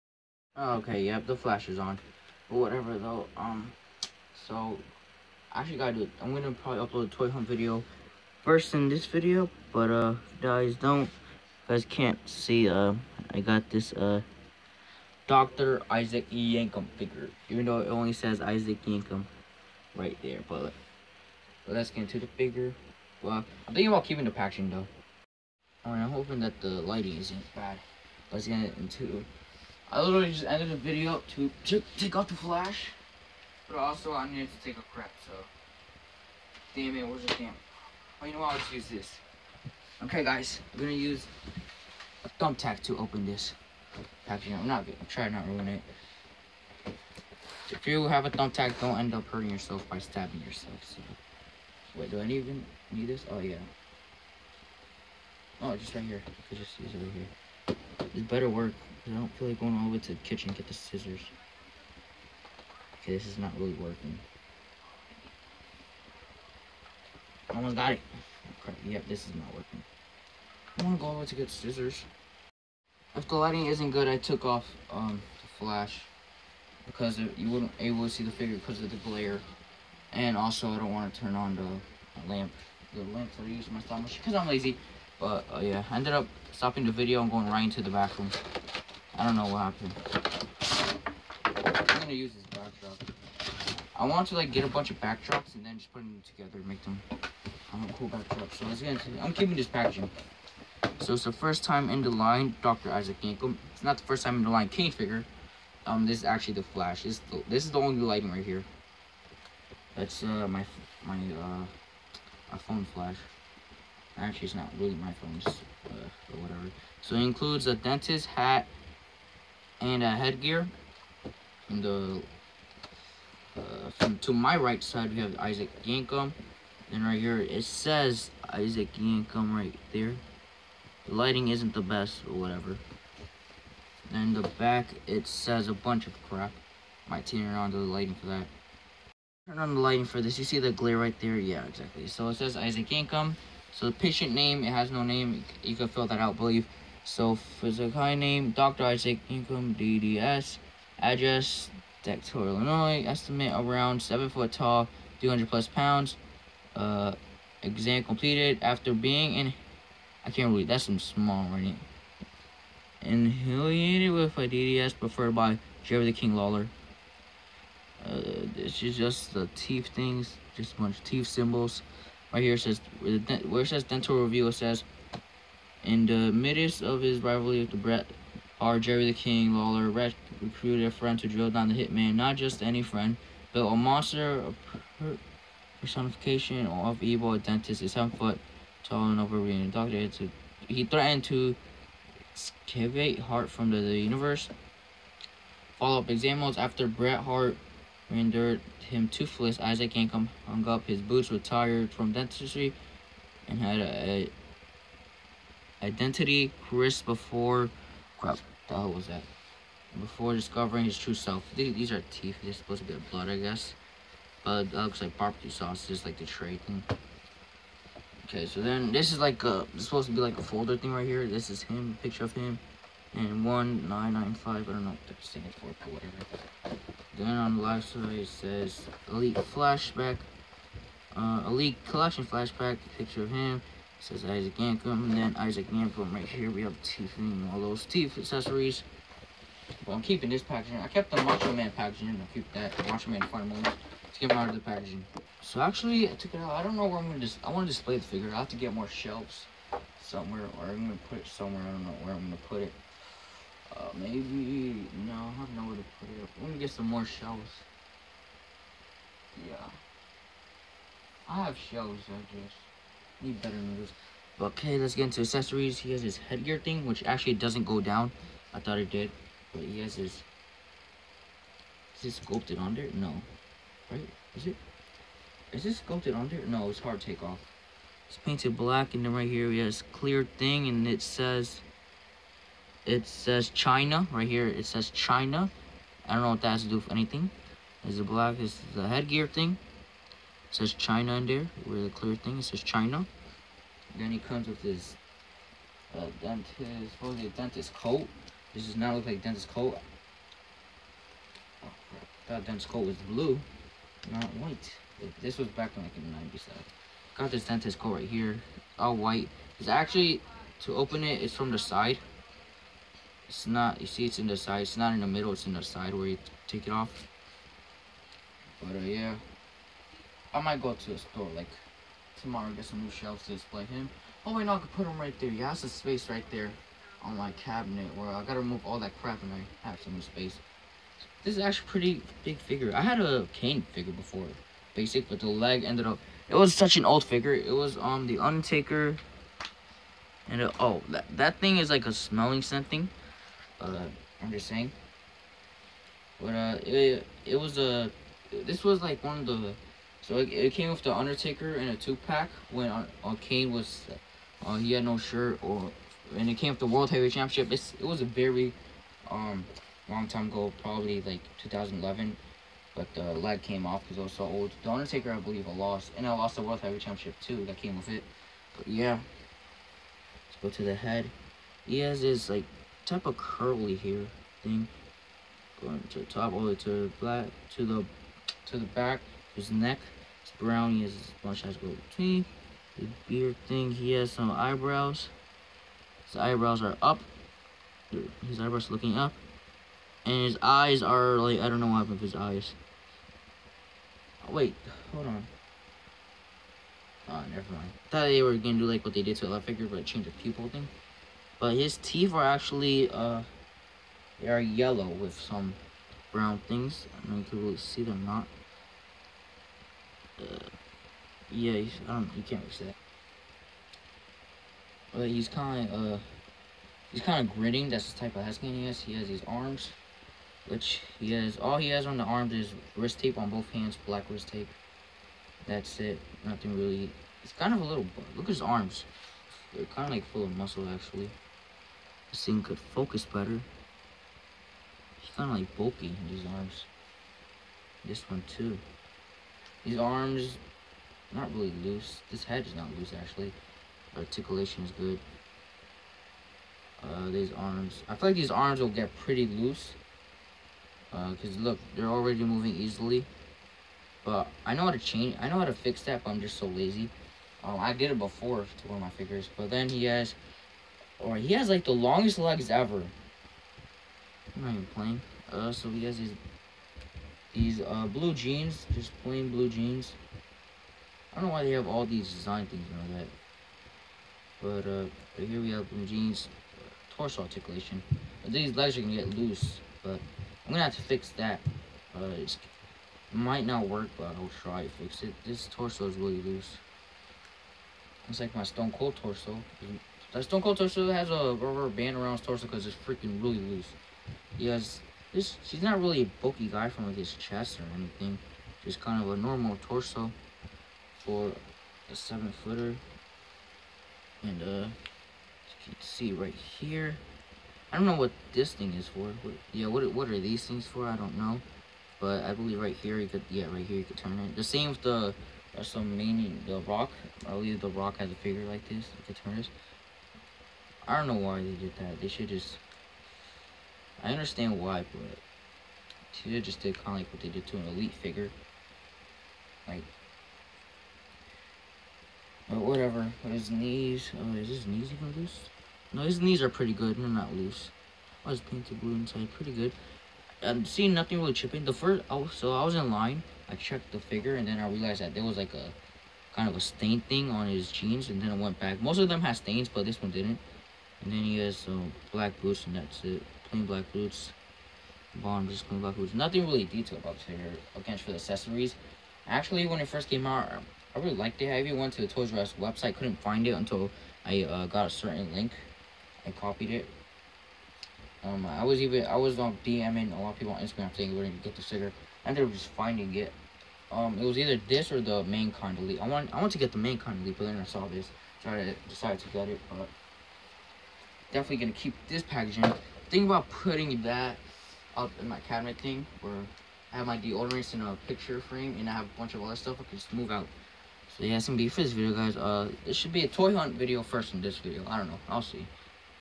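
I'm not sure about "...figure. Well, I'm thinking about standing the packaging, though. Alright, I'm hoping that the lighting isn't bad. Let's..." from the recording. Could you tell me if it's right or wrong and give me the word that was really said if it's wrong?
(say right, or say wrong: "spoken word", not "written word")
wrong: "keeping", not "standing".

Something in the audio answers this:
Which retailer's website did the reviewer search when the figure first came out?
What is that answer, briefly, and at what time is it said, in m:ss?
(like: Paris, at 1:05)
Toys R Us, at 9:22.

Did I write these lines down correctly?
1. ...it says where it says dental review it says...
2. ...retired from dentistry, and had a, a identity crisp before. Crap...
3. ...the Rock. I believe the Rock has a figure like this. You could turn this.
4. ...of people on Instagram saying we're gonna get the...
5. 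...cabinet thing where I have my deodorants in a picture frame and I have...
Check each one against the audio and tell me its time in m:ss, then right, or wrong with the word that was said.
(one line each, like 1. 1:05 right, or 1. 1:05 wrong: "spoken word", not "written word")
1. 2:52 right
2. 3:21 right
3. 8:36 right
4. 9:30 right
5. 9:45 right.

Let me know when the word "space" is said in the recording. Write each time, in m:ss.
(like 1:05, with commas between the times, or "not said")
5:25, 5:30.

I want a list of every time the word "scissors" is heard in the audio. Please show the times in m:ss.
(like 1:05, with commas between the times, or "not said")
1:00, 1:11.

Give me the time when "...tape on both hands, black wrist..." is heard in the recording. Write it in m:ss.
7:02.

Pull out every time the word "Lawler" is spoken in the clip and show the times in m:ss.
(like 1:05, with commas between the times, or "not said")
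2:46, 2:59.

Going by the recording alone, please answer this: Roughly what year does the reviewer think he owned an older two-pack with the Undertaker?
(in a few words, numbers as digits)
2011.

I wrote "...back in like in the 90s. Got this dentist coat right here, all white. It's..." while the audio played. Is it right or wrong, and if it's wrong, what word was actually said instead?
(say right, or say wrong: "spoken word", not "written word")
right.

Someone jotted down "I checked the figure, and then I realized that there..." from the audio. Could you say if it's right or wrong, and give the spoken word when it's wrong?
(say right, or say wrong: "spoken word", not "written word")
right.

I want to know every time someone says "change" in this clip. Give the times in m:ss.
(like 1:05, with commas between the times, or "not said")
6:39, 7:34.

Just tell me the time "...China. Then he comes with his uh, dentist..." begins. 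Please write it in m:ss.
4:52.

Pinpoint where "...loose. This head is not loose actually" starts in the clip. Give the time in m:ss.
7:21.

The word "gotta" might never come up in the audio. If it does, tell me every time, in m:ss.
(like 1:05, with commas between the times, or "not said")
0:05, 5:28.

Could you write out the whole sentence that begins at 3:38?
Okay, so then this is like a is supposed to be like a folder thing right here.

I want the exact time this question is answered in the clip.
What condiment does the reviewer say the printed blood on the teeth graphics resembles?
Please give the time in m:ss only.
3:35.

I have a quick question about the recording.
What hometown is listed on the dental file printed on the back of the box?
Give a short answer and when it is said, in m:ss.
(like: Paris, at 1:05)
Dexter, Illinois, at 2:32.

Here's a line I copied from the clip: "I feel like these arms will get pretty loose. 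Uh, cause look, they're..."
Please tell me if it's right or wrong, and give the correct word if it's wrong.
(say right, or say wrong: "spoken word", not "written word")
right.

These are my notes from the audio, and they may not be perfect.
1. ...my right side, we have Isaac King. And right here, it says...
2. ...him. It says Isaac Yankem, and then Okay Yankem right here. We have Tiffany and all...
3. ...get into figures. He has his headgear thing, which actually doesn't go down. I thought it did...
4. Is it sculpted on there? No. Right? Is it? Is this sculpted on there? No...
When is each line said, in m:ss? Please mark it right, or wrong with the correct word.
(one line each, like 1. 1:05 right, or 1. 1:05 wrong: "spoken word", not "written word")
1. 2:04 wrong: "Yankem", not "King"
2. 3:53 wrong: "Isaac", not "Okay"
3. 4:24 wrong: "accessories", not "figures"
4. 4:31 right.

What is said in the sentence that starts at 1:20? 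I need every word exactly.
And also, I don't want to turn on the lamp.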